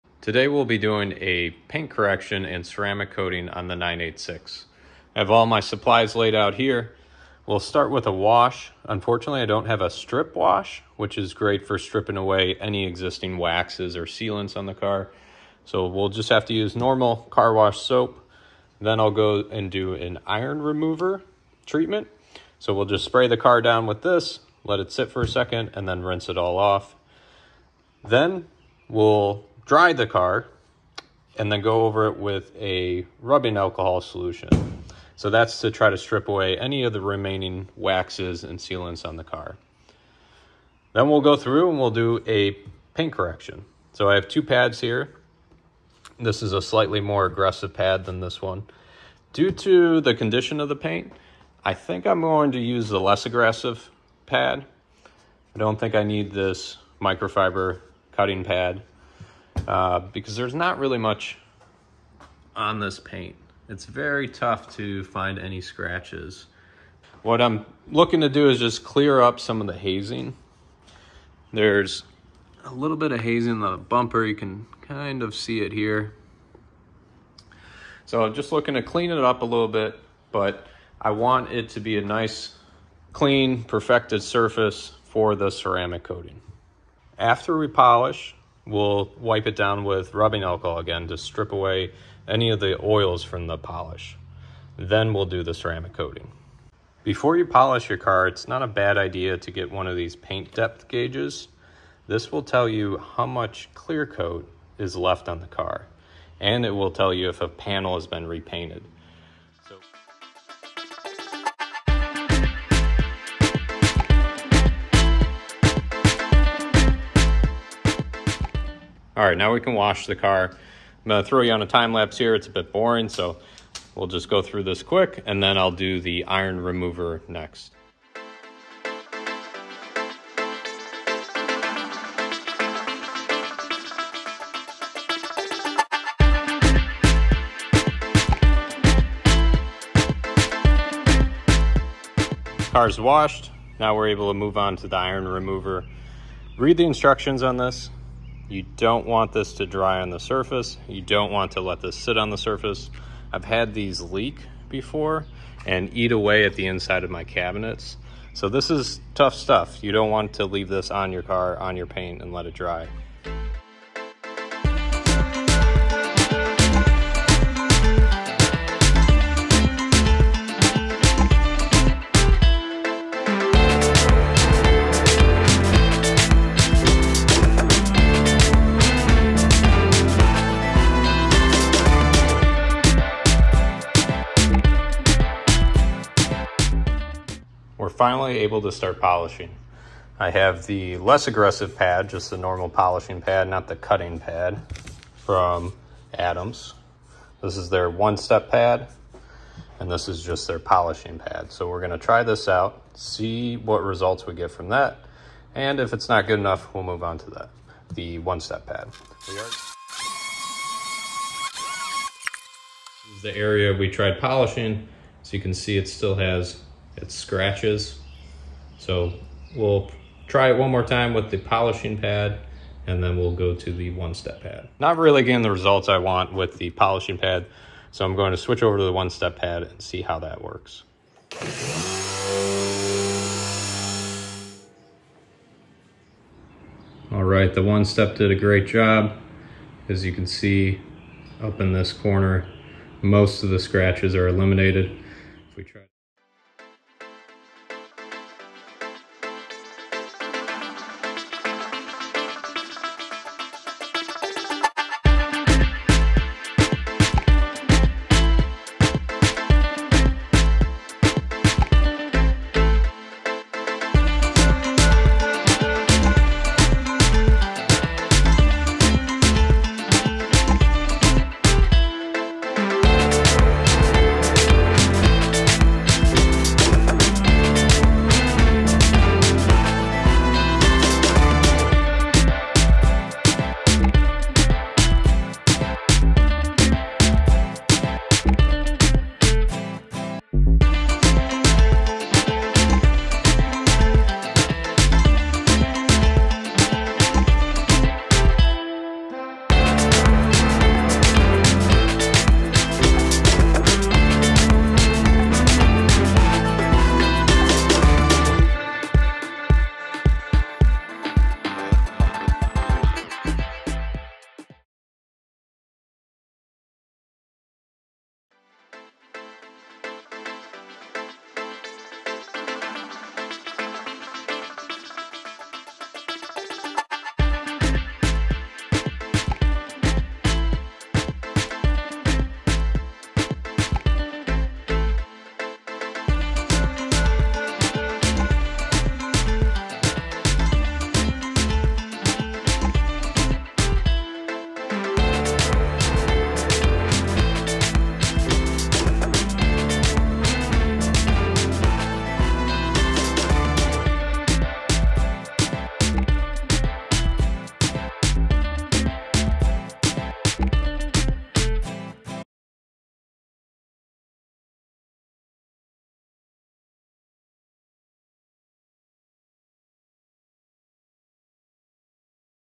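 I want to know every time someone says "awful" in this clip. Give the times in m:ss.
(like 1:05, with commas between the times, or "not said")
not said.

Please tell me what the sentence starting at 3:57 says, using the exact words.
All right, the one-step did a great job.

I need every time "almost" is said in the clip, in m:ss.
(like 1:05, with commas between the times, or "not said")
not said.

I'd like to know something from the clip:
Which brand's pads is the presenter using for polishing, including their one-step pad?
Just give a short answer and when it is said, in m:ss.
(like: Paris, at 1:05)
Adams, at 3:16.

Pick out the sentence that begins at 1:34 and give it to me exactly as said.
Then we'll do the ceramic coating.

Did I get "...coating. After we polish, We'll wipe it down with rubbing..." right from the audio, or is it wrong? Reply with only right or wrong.
right.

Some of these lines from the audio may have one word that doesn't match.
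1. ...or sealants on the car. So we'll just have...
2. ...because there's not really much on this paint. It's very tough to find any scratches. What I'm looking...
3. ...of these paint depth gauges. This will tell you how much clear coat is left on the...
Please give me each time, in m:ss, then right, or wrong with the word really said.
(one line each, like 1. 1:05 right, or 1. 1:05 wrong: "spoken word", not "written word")
1. 0:13 right
2. 0:59 right
3. 1:39 right.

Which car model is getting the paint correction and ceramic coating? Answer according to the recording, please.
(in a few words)
986.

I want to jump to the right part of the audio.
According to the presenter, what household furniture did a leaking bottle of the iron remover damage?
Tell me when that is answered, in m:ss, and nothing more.
2:37.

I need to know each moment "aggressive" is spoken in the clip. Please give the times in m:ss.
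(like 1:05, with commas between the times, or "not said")
0:47, 0:53, 3:11.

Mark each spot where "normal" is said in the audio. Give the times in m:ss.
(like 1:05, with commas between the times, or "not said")
0:16, 3:12.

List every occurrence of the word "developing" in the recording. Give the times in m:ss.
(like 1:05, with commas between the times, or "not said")
not said.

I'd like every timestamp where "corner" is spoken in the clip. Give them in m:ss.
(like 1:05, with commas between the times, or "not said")
4:01.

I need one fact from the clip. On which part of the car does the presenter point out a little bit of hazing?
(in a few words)
bumper.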